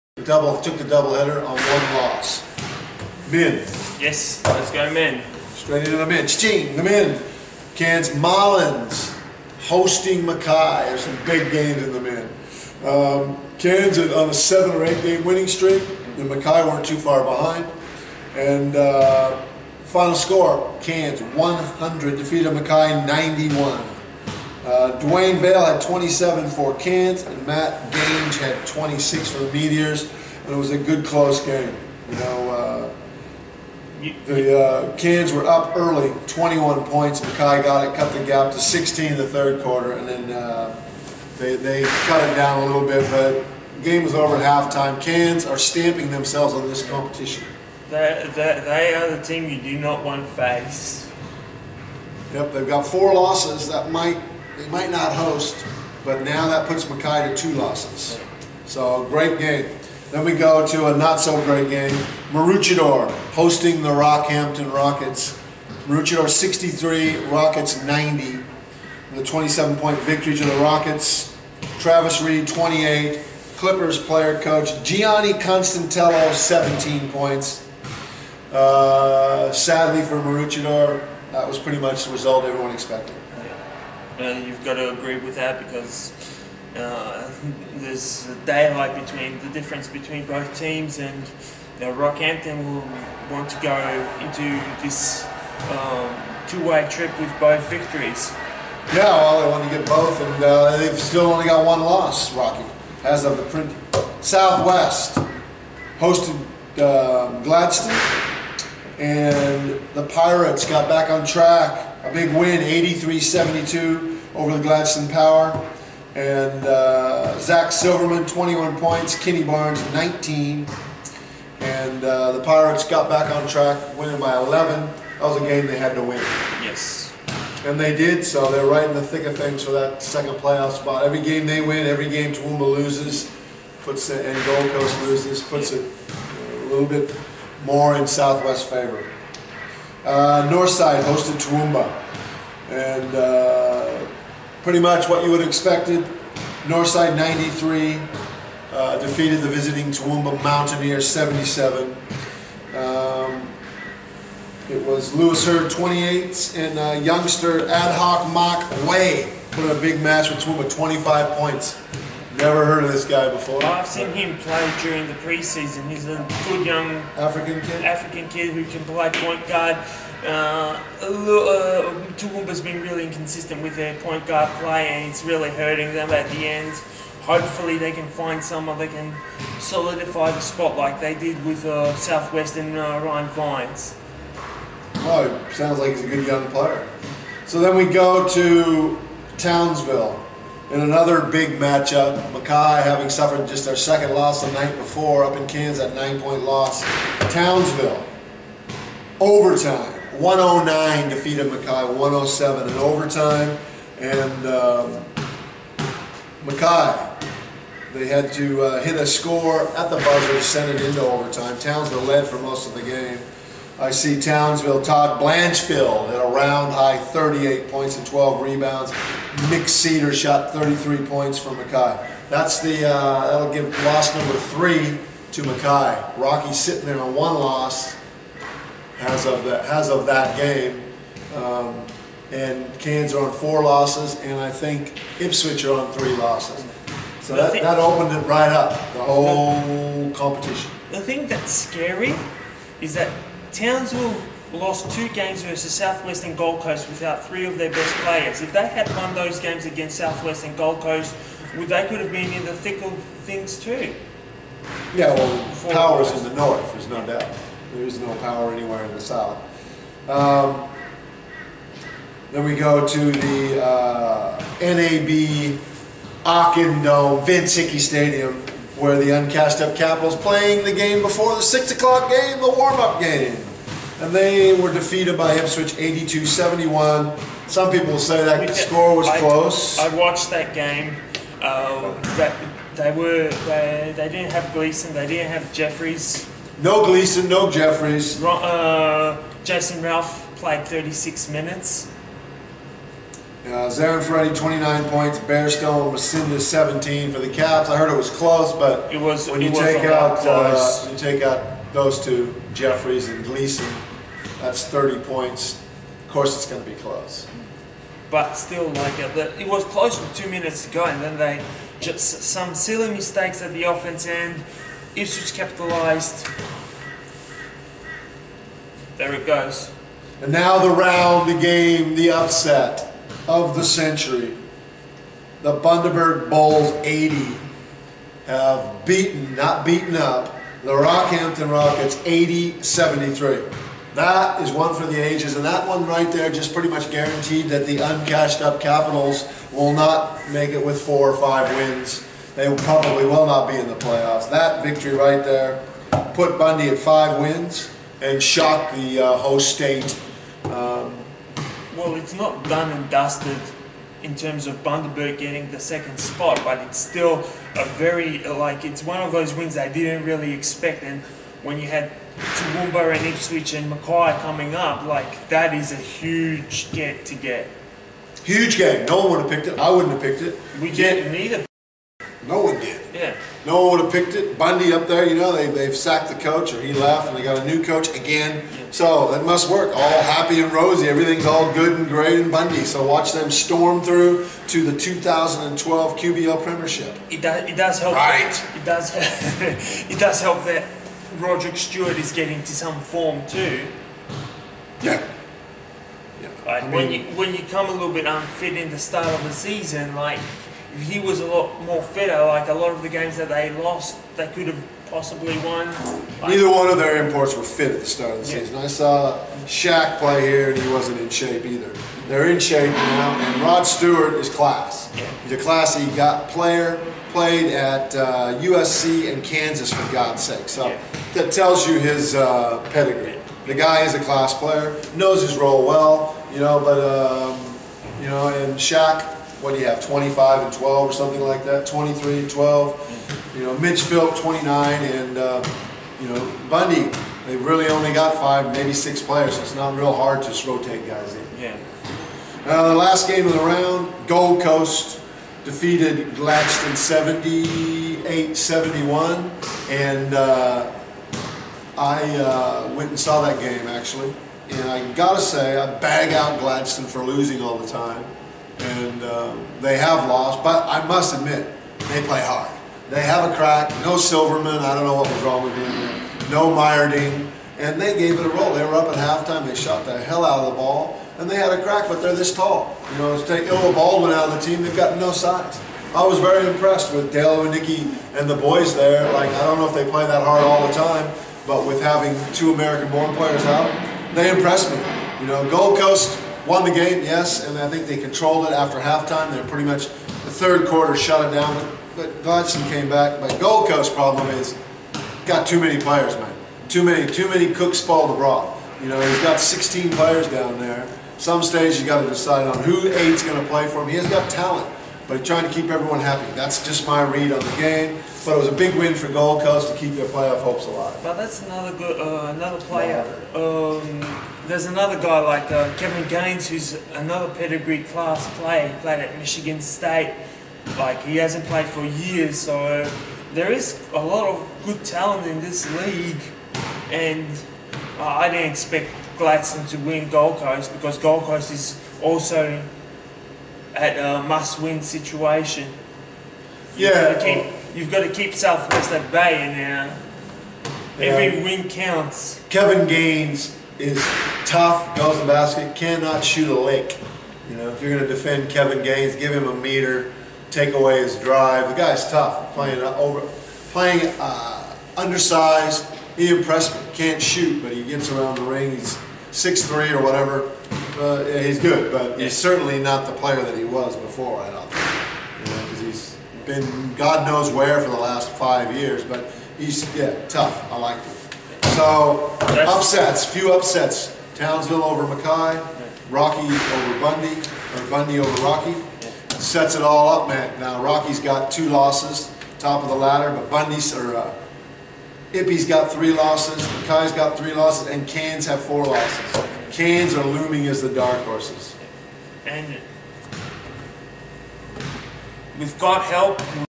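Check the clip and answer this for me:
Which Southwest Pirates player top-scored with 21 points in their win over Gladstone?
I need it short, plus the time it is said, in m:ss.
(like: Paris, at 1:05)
Zach Silverman, at 1:57.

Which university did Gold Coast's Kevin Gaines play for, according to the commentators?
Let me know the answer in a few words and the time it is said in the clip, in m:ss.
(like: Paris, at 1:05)
Michigan State, at 8:39.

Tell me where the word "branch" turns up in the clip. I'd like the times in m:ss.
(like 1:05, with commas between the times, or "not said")
not said.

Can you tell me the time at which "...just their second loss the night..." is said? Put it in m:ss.
3:13.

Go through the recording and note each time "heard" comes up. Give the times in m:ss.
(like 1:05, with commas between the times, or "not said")
2:42, 4:57.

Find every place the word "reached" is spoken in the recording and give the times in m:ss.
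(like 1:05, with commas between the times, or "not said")
not said.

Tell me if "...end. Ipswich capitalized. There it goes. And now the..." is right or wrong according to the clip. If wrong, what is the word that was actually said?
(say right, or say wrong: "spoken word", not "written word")
right.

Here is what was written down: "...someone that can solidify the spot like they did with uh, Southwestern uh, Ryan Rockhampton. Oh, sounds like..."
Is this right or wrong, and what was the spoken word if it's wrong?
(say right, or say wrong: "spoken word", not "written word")
wrong: "Vines", not "Rockhampton".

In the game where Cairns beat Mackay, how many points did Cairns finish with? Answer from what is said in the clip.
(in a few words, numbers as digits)
100.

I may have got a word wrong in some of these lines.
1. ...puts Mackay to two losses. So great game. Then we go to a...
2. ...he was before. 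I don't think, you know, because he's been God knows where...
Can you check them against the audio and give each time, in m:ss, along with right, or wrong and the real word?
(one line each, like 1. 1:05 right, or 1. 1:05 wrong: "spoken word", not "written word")
1. 0:56 right
2. 9:23 right.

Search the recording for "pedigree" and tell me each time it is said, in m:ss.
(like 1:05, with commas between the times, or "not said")
7:02, 8:37.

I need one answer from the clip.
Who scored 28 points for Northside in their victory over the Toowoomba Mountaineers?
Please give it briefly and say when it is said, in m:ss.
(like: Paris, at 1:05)
Lewis Hurd, at 2:35.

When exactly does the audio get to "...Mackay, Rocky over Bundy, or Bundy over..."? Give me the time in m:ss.
9:35.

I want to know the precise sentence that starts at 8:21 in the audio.
Some stage you got to decide on who eight's going to play for him.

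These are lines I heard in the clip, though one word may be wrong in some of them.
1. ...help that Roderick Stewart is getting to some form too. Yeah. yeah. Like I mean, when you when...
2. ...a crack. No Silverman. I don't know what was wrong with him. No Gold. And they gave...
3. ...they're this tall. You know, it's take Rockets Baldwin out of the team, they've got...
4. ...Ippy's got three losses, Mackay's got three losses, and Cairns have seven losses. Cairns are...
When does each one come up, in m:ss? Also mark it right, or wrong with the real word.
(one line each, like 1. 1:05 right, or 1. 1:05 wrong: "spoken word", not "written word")
1. 6:30 right
2. 7:43 wrong: "Myerding", not "Gold"
3. 7:52 wrong: "Ilwa", not "Rockets"
4. 9:45 wrong: "four", not "seven".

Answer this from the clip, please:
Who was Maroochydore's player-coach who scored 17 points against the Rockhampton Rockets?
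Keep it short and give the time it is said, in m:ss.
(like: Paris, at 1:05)
Gianni Constantello, at 1:14.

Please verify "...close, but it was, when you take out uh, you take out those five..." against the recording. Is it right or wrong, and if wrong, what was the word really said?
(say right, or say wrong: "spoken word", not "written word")
wrong: "two", not "five".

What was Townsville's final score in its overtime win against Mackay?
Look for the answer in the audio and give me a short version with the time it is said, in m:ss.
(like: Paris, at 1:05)
109, at 3:20.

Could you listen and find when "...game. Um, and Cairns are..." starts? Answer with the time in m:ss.
3:50.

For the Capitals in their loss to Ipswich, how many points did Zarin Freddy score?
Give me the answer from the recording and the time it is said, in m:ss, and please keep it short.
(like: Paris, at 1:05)
29, at 4:54.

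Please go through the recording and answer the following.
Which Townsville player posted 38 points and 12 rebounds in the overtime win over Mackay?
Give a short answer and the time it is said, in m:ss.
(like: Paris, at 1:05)
Todd Blanchfield, at 3:34.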